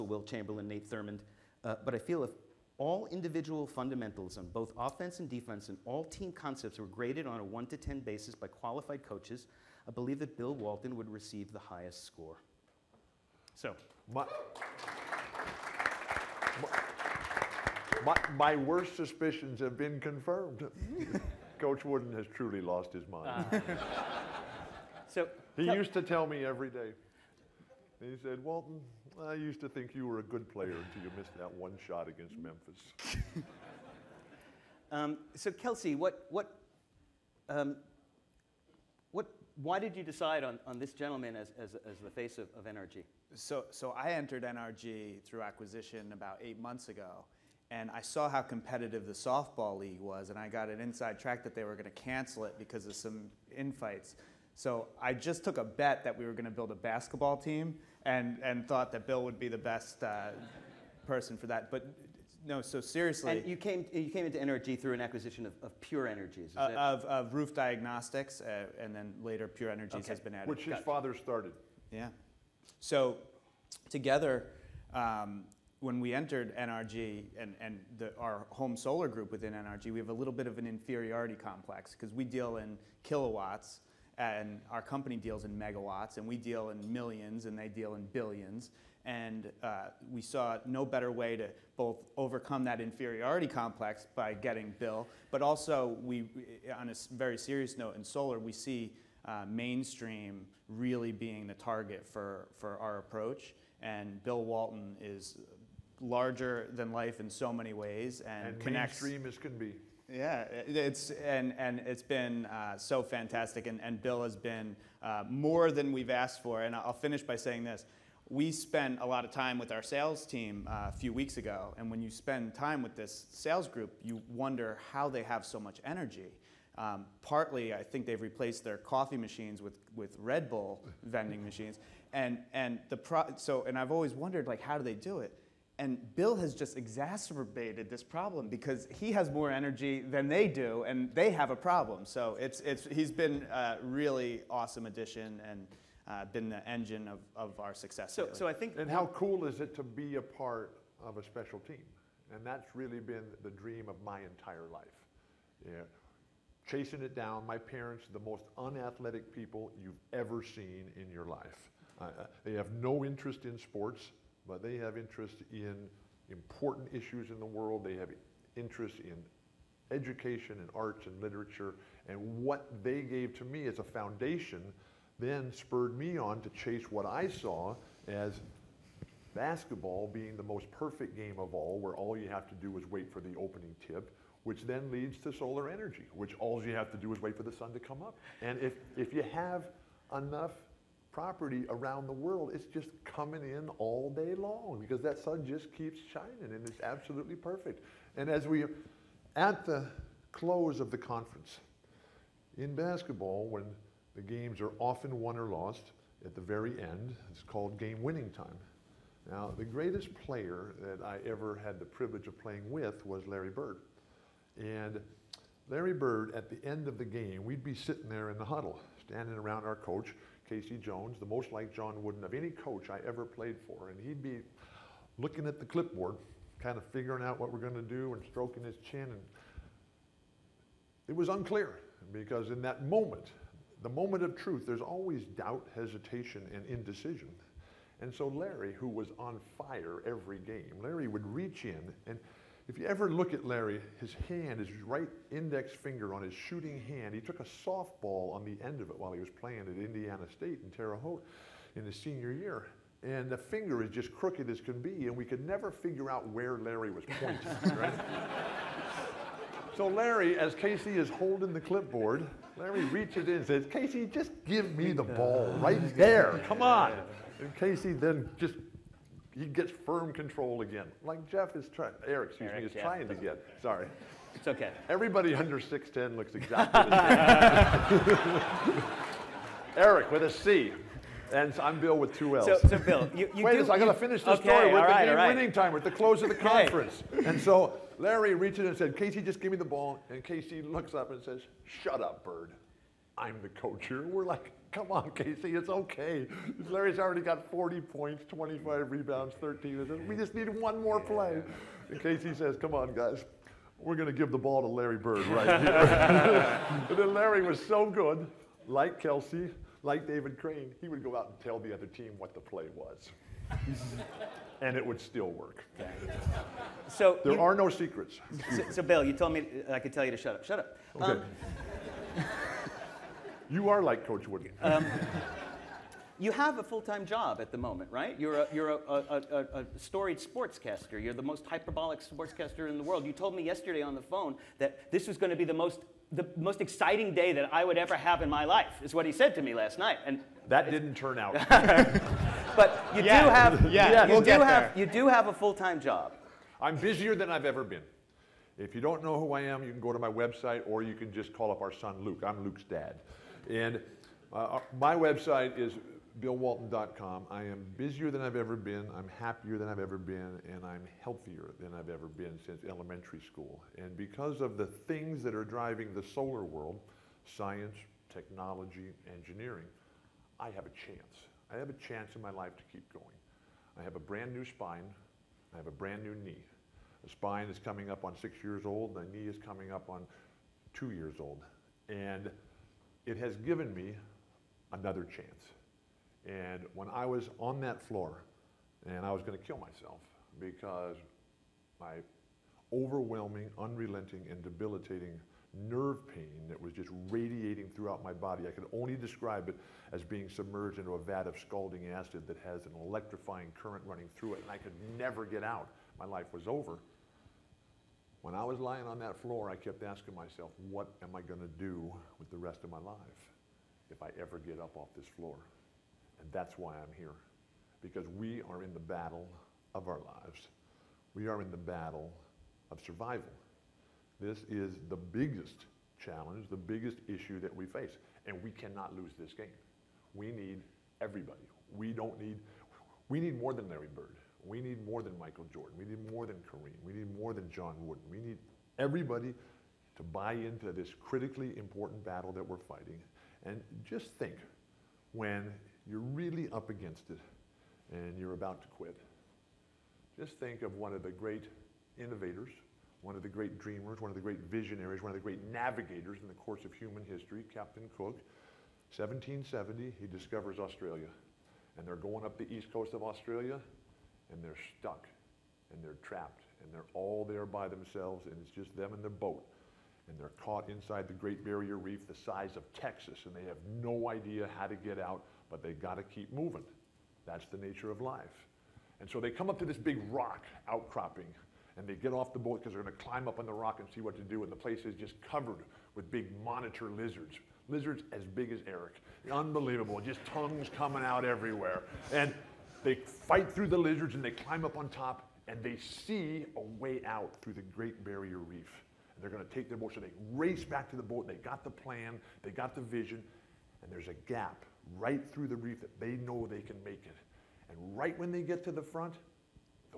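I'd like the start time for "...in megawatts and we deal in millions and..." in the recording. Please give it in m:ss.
1:25.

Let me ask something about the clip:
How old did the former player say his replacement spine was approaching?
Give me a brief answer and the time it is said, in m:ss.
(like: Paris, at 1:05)
6 years, at 6:18.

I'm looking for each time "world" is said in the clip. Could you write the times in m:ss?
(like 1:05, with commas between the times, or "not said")
2:47, 3:12, 5:32, 6:06.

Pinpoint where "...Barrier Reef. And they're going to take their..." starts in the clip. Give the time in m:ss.
8:18.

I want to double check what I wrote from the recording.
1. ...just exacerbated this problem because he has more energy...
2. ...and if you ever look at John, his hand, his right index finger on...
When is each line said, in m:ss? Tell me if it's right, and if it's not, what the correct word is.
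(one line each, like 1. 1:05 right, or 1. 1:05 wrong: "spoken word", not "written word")
1. 2:16 right
2. 4:02 wrong: "Larry", not "John".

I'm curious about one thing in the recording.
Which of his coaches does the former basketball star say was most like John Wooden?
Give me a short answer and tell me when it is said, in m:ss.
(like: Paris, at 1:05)
K.C. Jones, at 3:40.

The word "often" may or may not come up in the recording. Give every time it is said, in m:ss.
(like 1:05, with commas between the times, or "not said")
3:24.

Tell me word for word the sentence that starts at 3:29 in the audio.
Now, the greatest player that I ever had the privilege of playing with was Larry Bird.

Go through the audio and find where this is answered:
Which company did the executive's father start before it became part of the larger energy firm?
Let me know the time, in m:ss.
1:07.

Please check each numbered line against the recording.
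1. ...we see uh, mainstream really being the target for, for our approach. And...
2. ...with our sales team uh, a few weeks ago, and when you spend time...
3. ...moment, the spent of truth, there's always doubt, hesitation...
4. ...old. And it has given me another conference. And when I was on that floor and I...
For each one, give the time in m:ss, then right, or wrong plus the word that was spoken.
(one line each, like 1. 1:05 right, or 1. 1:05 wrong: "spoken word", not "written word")
1. 1:38 right
2. 1:59 right
3. 3:52 wrong: "moment", not "spent"
4. 6:21 wrong: "chance", not "conference".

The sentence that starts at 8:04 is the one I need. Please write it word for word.
And the place is just covered with big monitor lizards.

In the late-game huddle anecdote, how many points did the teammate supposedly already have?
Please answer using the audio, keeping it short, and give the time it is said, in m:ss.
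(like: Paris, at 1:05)
40, at 4:57.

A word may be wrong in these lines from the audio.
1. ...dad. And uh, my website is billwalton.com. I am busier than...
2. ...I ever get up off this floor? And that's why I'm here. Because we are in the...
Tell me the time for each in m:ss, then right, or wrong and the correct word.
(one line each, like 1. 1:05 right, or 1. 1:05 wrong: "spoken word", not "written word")
1. 5:52 right
2. 6:54 right.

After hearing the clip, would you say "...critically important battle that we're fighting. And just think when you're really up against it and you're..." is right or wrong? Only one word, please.
right.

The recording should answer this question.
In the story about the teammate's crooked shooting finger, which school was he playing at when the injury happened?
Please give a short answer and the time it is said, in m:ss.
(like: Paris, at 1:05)
Indiana State, at 4:09.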